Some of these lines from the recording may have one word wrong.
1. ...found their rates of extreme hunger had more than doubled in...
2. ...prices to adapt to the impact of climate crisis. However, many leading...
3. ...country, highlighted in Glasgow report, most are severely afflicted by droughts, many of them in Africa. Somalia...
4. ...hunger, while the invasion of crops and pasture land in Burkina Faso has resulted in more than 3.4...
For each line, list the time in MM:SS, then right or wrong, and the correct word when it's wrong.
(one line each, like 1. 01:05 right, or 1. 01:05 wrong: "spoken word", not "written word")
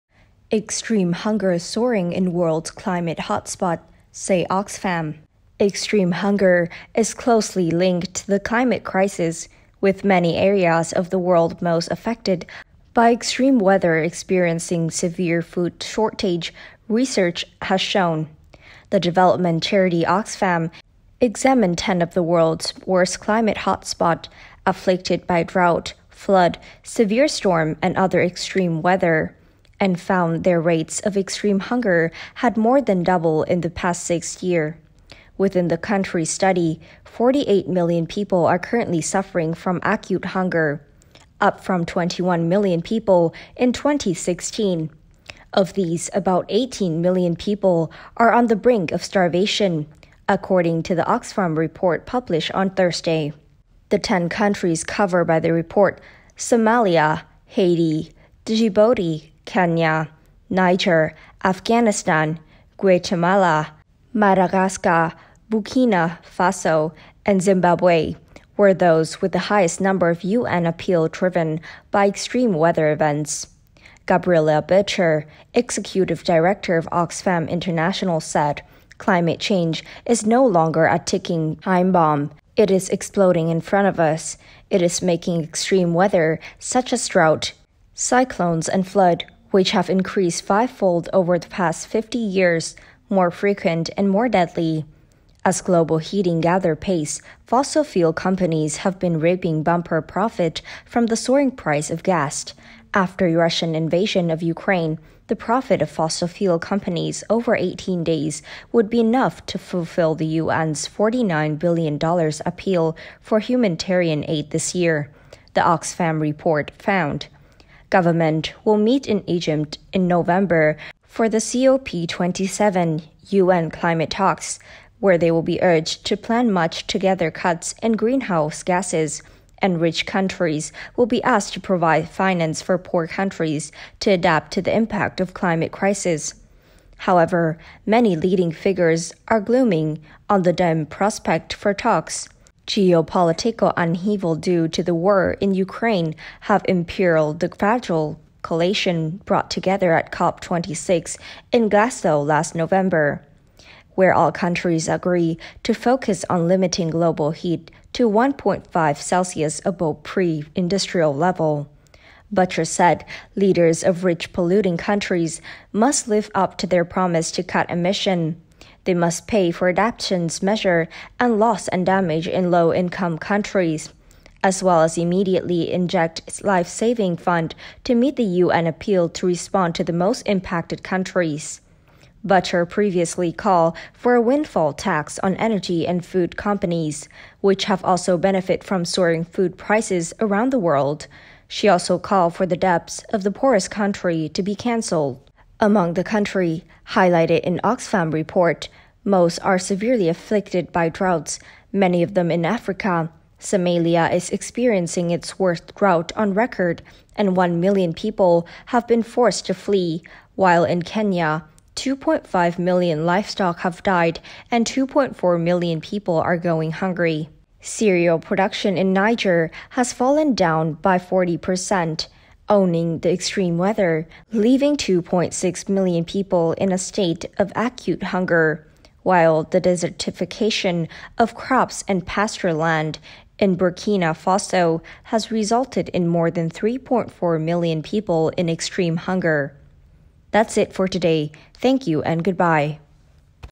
1. 00:29 right
2. 02:13 wrong: "countries", not "prices"
3. 03:16 wrong: "Oxfam", not "Glasgow"
4. 03:48 wrong: "desertification", not "invasion".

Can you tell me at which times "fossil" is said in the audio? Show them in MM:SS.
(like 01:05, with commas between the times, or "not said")
01:37, 01:45.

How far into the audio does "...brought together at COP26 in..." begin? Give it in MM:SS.
02:29.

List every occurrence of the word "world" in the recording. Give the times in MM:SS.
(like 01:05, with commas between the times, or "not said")
00:02, 00:11, 00:22, 03:10.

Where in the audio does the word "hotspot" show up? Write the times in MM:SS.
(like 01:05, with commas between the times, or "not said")
00:03, 00:23.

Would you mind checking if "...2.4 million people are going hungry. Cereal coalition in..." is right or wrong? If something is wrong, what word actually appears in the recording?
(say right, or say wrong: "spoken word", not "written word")
wrong: "production", not "coalition".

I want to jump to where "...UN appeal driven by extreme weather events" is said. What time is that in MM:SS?
01:10.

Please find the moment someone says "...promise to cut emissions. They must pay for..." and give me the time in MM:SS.
02:46.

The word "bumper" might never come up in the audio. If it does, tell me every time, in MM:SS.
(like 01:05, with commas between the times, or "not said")
01:39.